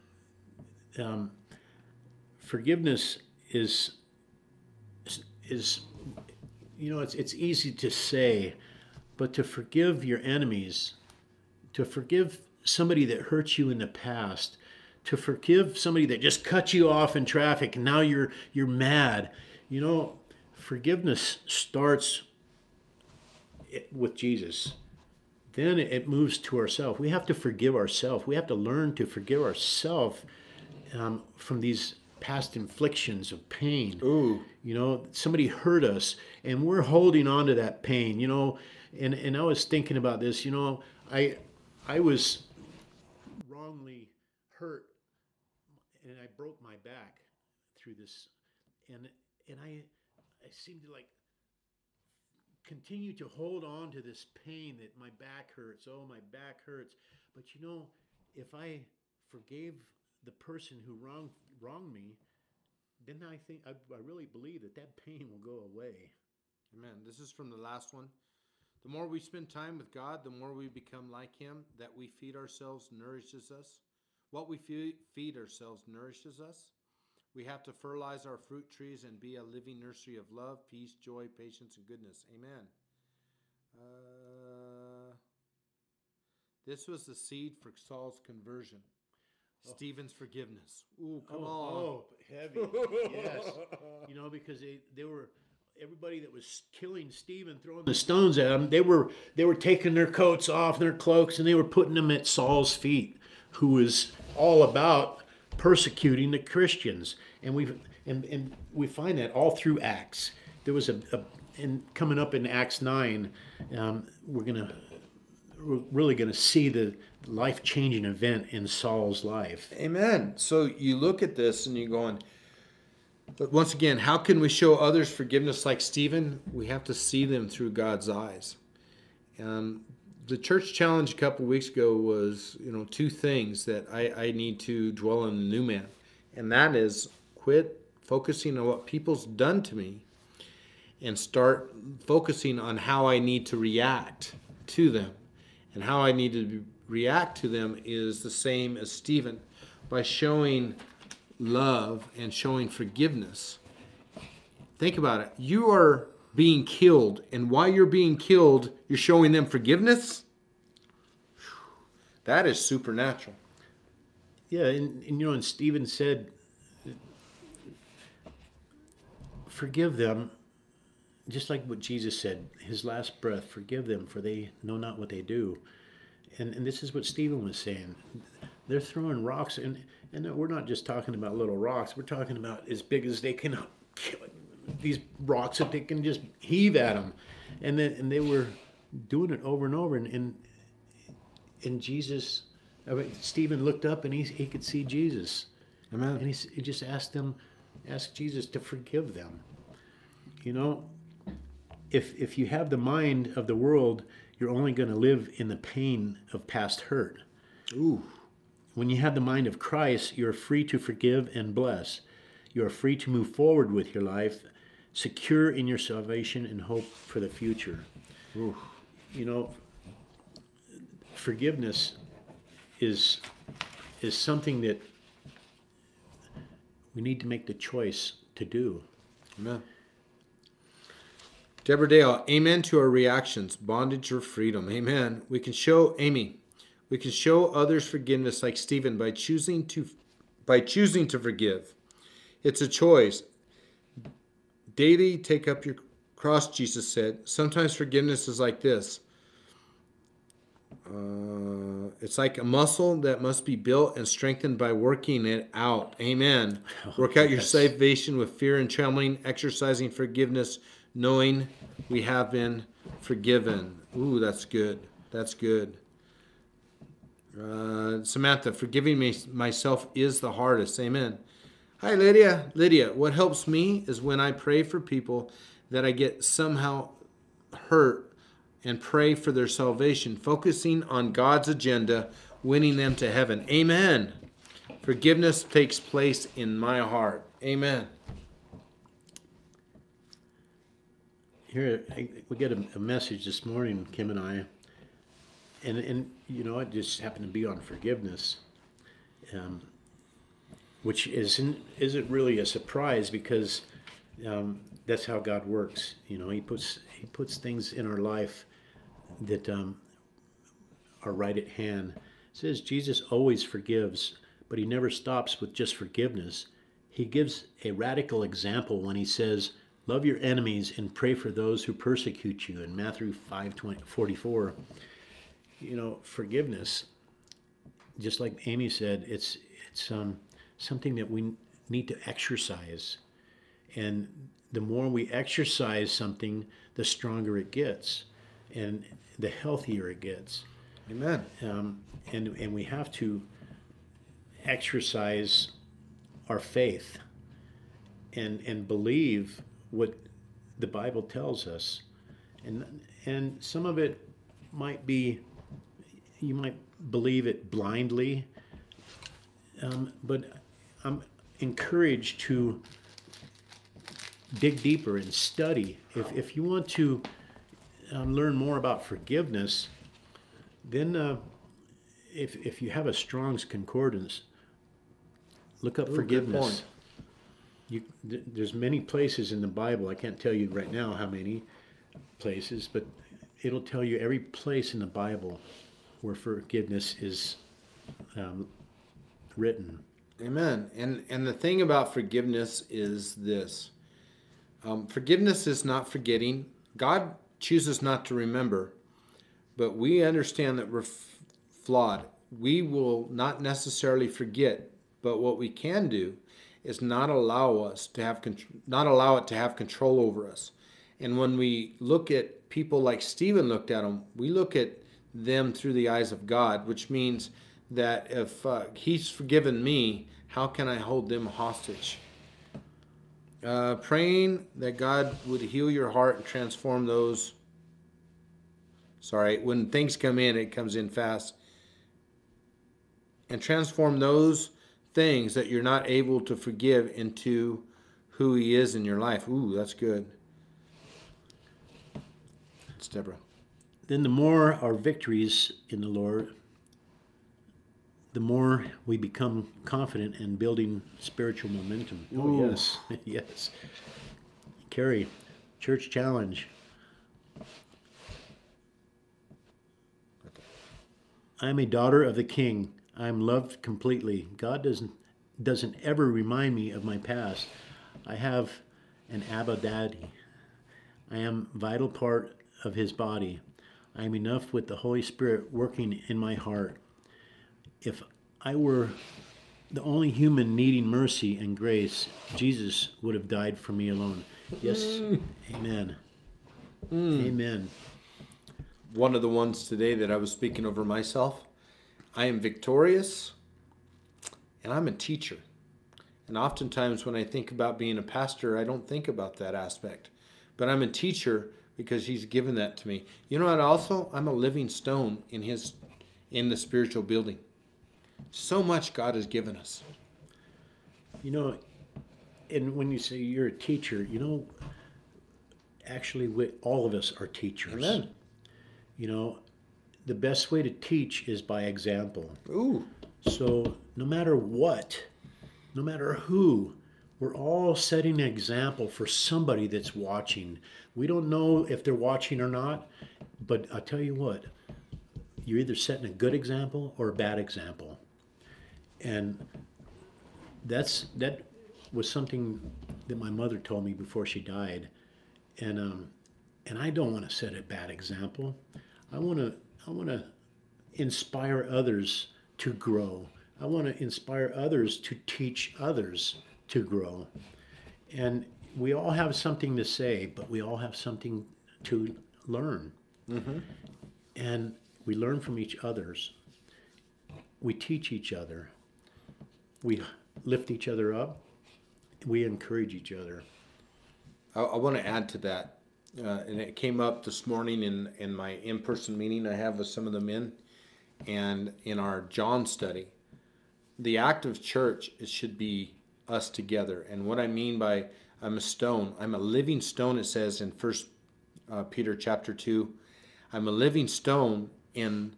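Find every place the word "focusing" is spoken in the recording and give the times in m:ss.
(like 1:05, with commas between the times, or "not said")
2:18, 2:22, 4:40.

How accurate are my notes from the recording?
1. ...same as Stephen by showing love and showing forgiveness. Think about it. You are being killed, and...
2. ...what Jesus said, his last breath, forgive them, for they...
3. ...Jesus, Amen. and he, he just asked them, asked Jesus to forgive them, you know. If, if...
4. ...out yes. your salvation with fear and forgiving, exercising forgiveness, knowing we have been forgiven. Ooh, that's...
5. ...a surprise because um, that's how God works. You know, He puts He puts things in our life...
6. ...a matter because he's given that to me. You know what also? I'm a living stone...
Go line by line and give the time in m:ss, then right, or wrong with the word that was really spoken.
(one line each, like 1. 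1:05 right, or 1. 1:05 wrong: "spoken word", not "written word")
1. 2:28 right
2. 2:51 right
3. 3:14 right
4. 4:17 wrong: "trembling", not "forgiving"
5. 5:02 right
6. 8:20 wrong: "teacher", not "matter".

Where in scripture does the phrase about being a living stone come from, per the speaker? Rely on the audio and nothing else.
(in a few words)
First Peter chapter 2.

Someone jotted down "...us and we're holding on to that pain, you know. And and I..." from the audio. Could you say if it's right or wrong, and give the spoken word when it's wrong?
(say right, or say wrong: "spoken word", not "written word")
right.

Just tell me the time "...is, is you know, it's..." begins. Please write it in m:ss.
0:05.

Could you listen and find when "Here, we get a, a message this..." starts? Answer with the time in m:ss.
4:51.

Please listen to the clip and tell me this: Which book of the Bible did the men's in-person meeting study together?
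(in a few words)
John.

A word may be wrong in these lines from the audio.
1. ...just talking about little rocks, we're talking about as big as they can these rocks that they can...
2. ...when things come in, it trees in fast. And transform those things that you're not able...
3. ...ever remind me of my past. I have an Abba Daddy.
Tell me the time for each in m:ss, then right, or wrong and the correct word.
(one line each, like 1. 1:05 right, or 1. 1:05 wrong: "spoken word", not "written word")
1. 3:00 right
2. 7:09 wrong: "comes", not "trees"
3. 7:45 right.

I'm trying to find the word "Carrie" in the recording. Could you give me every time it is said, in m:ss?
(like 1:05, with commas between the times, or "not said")
7:34.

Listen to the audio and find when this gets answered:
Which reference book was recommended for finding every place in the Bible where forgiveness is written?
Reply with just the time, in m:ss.
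6:12.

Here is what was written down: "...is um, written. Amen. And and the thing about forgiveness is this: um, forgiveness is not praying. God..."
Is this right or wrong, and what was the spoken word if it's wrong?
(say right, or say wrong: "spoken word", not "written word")
wrong: "forgetting", not "praying".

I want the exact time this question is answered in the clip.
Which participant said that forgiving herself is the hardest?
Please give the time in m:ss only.
4:28.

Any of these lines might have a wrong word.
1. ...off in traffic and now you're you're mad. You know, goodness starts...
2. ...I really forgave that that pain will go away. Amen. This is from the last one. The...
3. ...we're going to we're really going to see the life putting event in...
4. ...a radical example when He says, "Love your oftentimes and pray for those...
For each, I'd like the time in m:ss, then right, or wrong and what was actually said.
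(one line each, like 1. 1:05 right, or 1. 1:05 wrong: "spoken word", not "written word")
1. 0:16 wrong: "forgiveness", not "goodness"
2. 1:03 wrong: "believe", not "forgave"
3. 1:54 wrong: "changing", not "putting"
4. 5:17 wrong: "enemies", not "oftentimes".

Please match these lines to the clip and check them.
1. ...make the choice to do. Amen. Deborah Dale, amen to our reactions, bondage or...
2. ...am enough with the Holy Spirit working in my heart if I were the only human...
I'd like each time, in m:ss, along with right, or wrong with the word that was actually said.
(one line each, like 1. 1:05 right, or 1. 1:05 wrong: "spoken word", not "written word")
1. 3:47 right
2. 7:54 right.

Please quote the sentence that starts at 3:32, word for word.
You are free to move forward with your life secure in your salvation and hope for the future.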